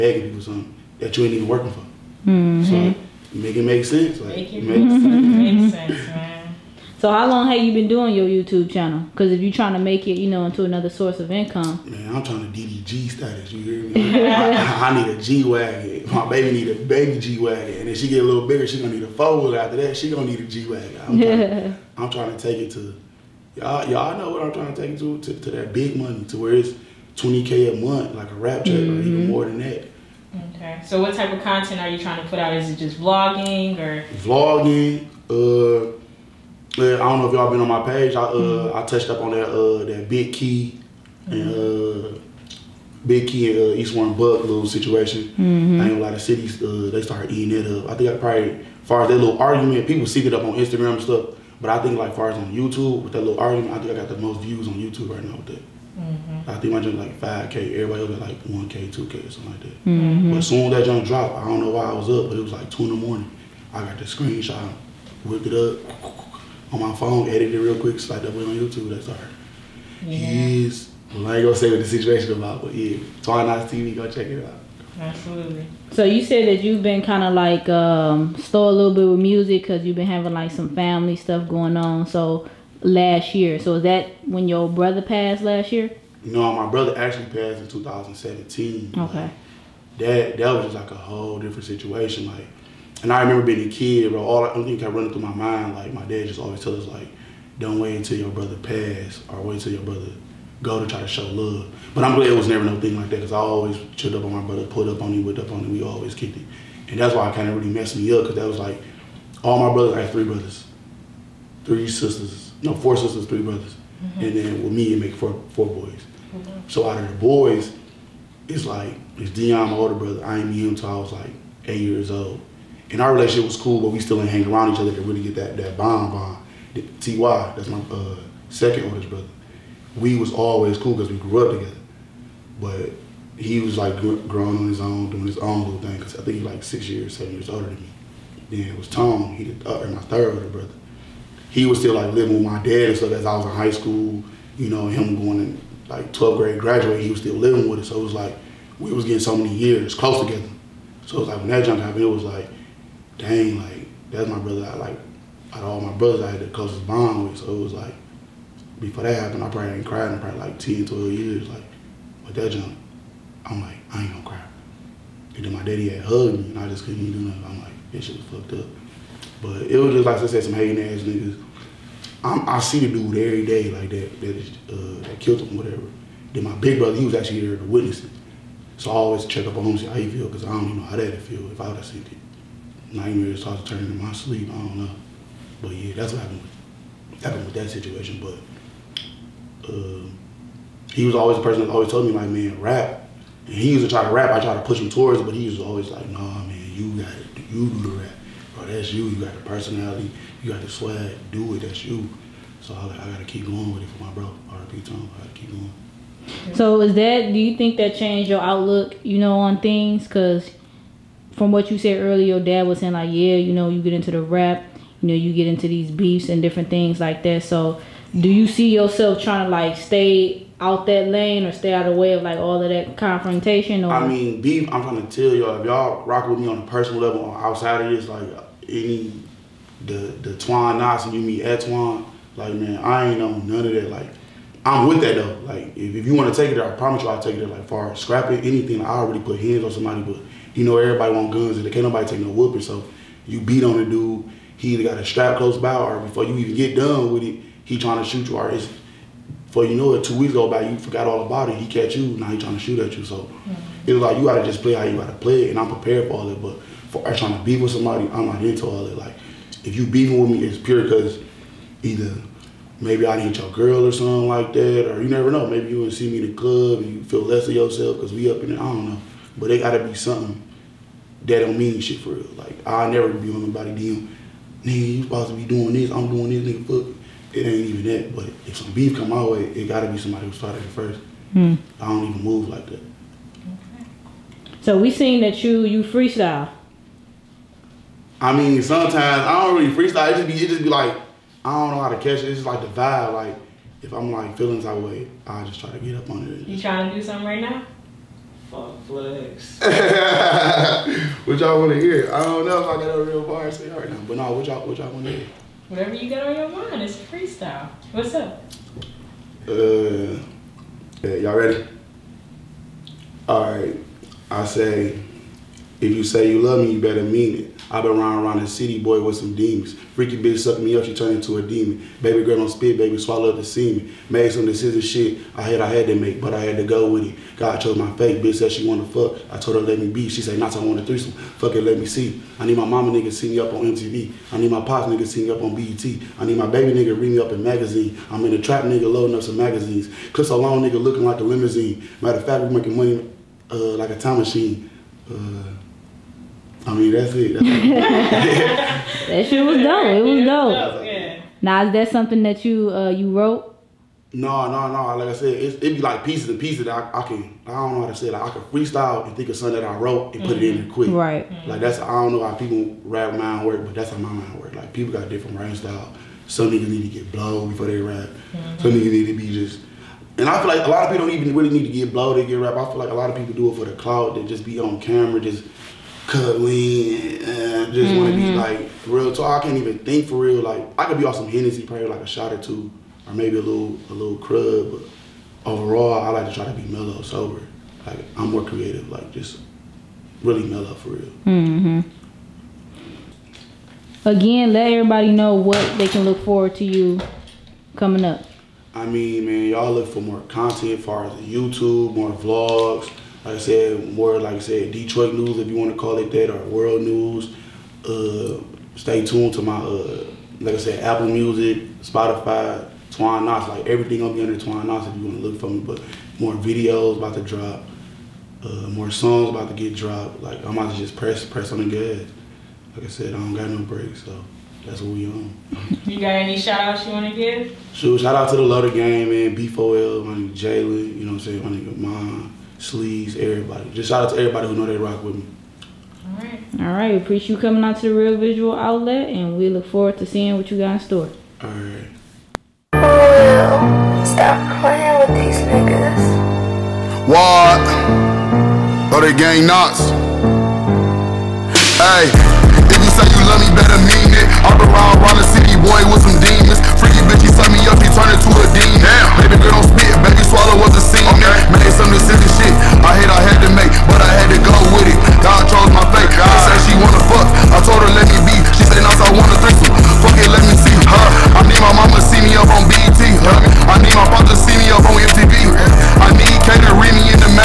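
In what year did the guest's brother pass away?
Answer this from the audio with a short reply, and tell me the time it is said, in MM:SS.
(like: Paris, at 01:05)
2017, at 01:27.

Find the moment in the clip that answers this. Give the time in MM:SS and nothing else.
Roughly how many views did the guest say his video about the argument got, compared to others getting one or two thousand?
00:57.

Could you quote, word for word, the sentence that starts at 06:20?
Like I could be on some Hennessy, probably like a shot or two, or maybe a little a little crud.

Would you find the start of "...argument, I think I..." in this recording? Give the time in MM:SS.
00:53.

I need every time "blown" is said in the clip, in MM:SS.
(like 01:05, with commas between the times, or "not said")
06:07, 06:11.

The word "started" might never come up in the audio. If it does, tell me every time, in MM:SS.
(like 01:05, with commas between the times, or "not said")
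00:47, 03:03, 04:40.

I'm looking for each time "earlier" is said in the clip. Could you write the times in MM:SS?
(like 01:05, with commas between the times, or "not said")
03:32.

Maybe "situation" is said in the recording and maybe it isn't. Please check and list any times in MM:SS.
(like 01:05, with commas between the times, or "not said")
00:44, 01:11, 01:31, 03:07.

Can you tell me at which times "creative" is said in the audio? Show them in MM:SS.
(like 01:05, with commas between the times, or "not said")
06:28.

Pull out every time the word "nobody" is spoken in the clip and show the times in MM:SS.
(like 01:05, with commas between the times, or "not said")
04:01, 04:33.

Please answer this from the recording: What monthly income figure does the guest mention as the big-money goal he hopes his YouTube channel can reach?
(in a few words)
20k.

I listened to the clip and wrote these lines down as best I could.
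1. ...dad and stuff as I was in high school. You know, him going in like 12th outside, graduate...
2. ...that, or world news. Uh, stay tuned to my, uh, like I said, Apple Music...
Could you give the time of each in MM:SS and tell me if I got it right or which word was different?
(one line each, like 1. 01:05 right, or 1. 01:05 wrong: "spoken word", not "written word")
1. 02:22 wrong: "grade", not "outside"
2. 06:46 right.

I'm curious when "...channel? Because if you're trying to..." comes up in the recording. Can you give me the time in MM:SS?
00:08.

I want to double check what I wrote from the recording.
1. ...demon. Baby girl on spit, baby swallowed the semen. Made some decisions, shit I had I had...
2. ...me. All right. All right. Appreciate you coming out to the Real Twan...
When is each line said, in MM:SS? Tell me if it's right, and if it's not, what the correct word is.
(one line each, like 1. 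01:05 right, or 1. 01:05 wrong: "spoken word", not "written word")
1. 05:21 right
2. 07:15 wrong: "Visual", not "Twan".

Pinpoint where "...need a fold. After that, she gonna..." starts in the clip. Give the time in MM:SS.
00:18.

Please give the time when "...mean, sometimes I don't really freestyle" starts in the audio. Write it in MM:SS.
04:48.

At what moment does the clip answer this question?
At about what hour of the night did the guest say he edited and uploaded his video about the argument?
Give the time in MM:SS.
01:02.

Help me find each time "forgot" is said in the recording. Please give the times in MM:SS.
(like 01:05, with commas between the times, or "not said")
04:10.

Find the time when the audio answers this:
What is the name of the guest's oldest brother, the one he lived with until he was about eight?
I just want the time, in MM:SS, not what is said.
01:59.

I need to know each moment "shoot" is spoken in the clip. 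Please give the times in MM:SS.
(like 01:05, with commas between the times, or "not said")
04:08, 04:12.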